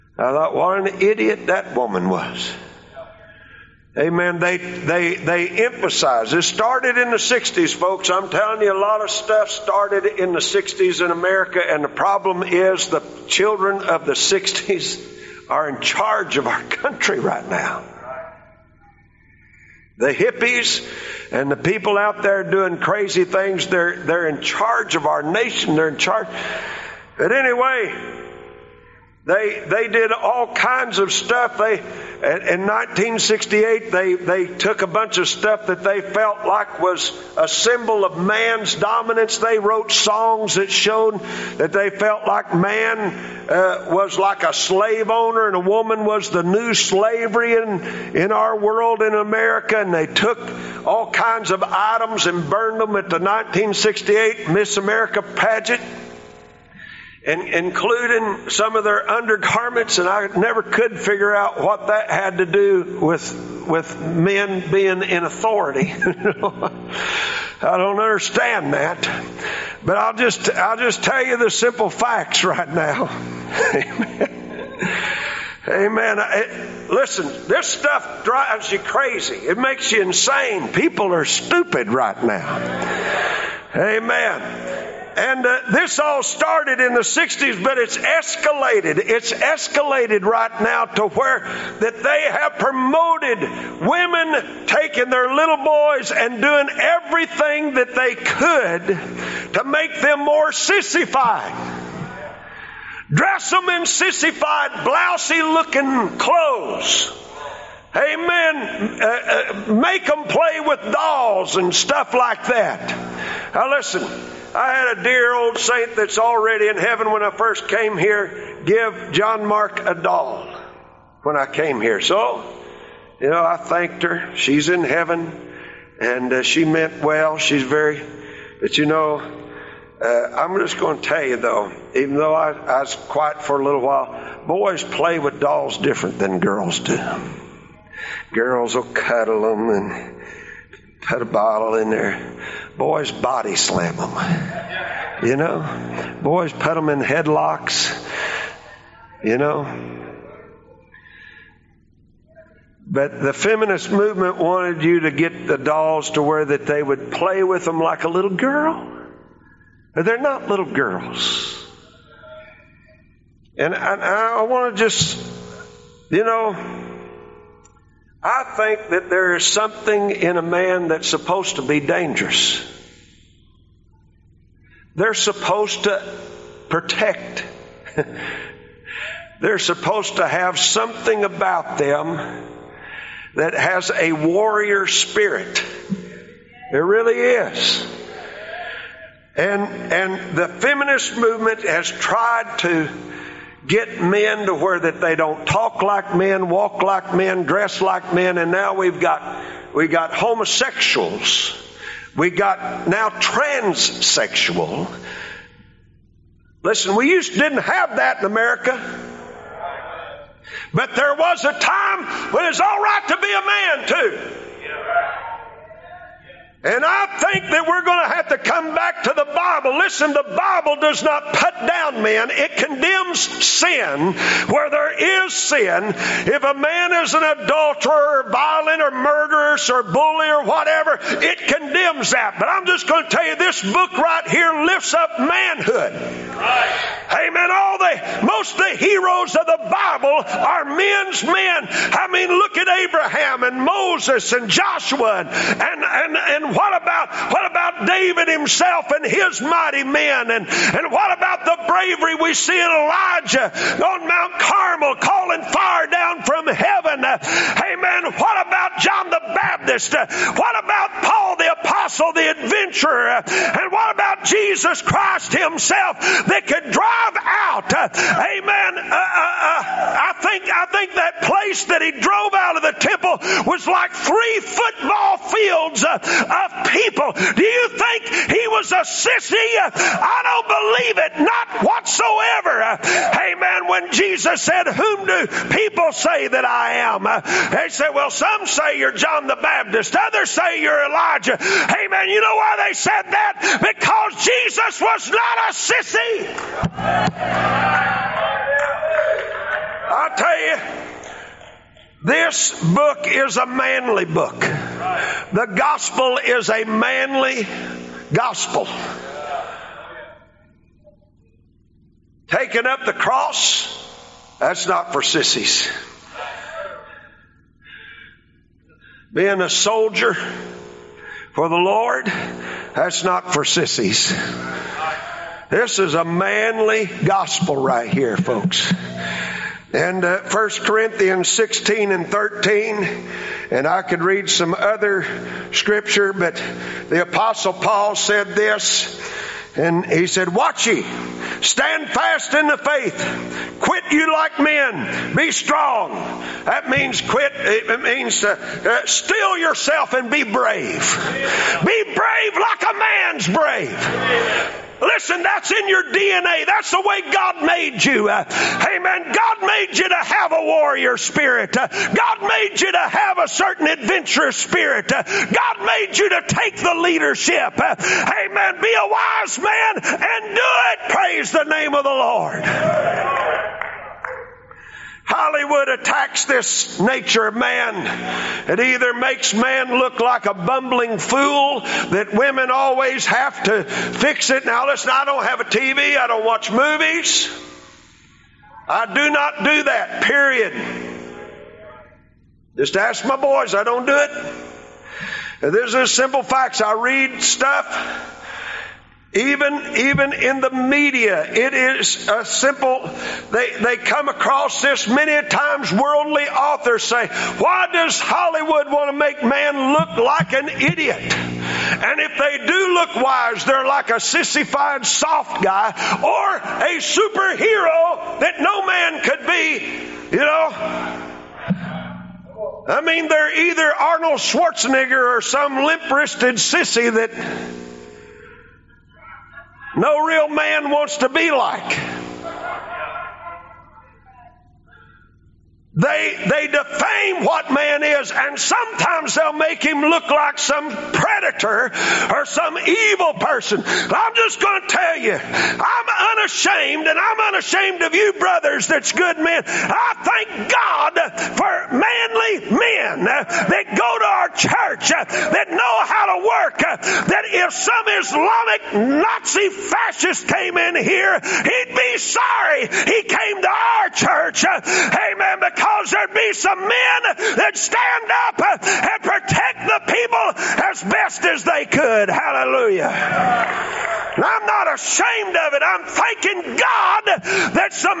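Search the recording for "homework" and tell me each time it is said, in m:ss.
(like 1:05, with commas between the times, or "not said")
not said.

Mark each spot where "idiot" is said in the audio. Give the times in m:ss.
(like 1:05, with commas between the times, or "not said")
0:01, 6:50.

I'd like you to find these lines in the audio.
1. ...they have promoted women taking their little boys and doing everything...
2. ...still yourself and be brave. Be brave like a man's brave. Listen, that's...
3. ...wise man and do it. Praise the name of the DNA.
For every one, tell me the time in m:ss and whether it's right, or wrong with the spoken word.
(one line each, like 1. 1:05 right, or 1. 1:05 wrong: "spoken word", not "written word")
1. 1:32 right
2. 5:49 right
3. 6:08 wrong: "Lord", not "DNA".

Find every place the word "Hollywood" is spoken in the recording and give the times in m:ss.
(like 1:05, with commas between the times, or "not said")
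6:15, 6:47.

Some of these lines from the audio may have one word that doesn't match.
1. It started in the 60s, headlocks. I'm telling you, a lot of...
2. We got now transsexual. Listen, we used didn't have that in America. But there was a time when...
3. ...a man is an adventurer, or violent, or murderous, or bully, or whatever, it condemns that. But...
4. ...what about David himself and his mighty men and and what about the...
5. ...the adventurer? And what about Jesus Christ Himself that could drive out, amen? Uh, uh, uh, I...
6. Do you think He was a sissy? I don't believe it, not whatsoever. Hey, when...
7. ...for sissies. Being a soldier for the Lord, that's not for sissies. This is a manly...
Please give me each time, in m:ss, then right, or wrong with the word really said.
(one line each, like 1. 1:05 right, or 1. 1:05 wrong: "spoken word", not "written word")
1. 0:06 wrong: "folks", not "headlocks"
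2. 3:22 right
3. 3:46 wrong: "adulterer", not "adventurer"
4. 4:07 right
5. 4:22 right
6. 4:37 right
7. 5:14 right.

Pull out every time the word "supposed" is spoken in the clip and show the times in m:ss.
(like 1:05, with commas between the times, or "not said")
2:51, 2:55, 2:59.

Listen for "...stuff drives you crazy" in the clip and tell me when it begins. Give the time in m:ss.
1:17.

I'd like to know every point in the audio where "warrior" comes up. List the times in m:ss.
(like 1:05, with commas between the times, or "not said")
3:04, 6:00.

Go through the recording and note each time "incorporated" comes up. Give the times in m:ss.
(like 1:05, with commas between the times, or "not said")
not said.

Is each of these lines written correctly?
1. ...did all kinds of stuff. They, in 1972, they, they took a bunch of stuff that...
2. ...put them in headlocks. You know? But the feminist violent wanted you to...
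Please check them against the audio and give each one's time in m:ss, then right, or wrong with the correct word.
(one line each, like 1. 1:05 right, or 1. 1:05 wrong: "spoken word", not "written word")
1. 0:29 wrong: "1968", not "1972"
2. 2:26 wrong: "movement", not "violent".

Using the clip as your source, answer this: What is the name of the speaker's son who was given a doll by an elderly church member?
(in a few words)
John Mark.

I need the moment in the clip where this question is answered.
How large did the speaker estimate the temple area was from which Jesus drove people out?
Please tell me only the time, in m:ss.
4:33.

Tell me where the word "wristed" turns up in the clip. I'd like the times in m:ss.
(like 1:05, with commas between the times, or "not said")
7:05.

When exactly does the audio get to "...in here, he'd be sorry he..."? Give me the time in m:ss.
7:40.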